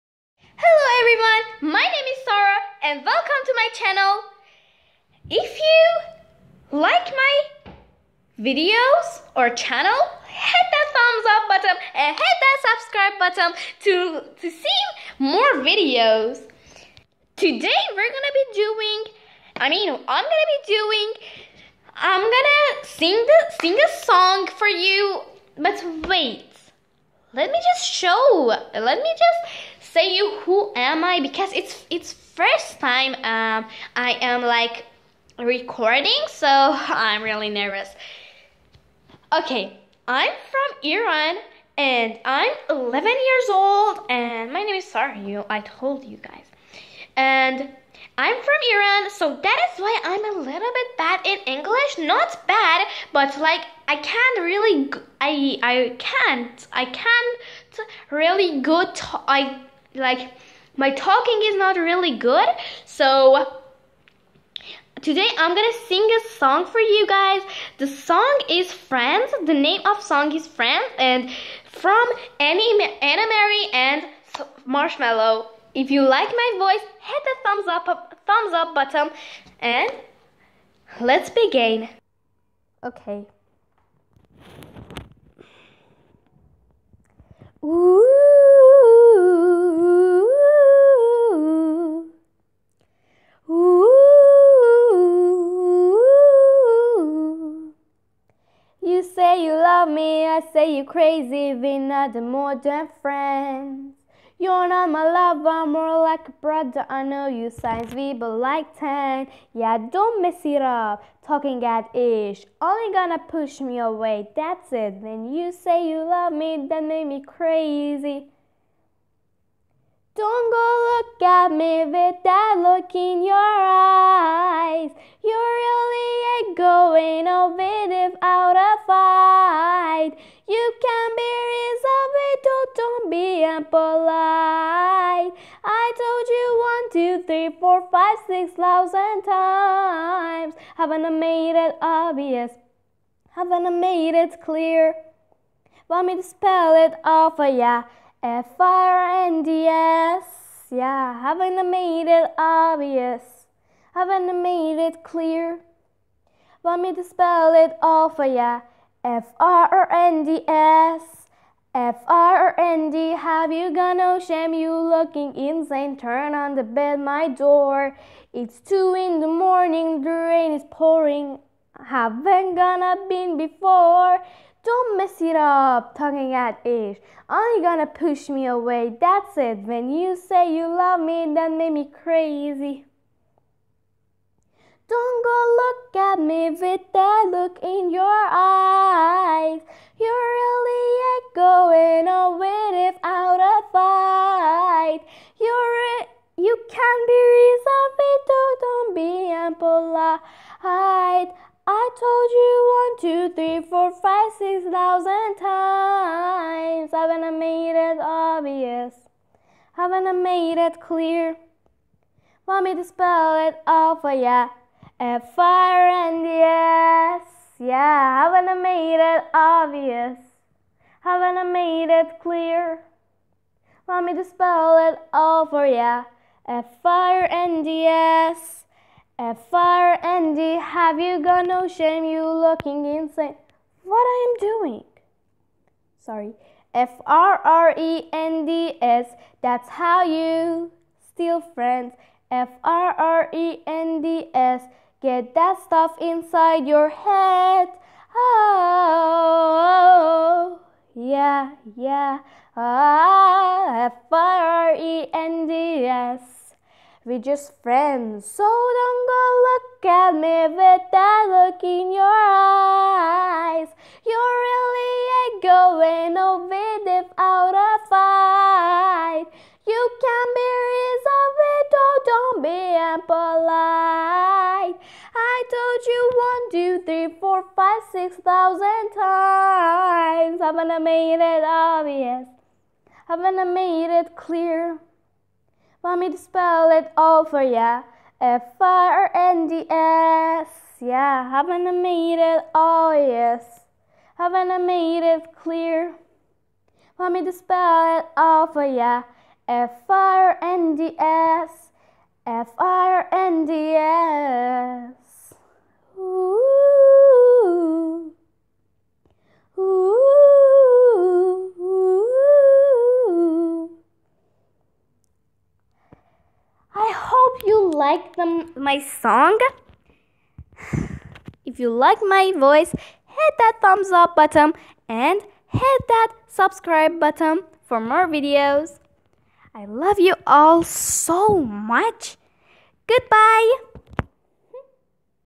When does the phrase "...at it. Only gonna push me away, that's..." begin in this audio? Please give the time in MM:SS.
02:56.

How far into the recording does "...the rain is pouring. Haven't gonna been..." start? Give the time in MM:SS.
02:50.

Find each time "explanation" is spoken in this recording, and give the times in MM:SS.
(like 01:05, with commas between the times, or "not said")
not said.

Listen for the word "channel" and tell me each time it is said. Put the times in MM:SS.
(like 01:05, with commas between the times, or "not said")
00:03, 00:09.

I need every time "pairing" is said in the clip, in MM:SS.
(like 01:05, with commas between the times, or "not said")
not said.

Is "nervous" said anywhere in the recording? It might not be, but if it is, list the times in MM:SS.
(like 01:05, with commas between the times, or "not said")
00:37.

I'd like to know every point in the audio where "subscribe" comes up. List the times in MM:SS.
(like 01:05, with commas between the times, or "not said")
00:12, 05:26.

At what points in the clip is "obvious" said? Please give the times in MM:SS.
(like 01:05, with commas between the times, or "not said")
02:21, 02:32, 03:28, 03:39, 04:41, 04:52.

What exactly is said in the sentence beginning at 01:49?
Yeah, don't mess it up, talking at ish.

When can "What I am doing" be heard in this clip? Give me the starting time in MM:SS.
03:53.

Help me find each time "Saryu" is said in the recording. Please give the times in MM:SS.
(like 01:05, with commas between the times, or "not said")
00:44.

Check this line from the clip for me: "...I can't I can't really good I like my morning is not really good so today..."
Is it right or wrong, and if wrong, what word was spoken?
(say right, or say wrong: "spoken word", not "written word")
wrong: "talking", not "morning".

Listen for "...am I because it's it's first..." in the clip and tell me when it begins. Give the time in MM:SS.
00:30.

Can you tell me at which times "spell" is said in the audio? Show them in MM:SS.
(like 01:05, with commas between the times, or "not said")
02:26, 02:37, 03:32, 03:44, 04:46, 04:57.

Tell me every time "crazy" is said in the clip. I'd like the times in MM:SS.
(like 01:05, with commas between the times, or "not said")
01:40, 01:57, 03:02.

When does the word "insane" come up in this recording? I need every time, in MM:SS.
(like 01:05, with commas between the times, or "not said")
02:45, 03:52.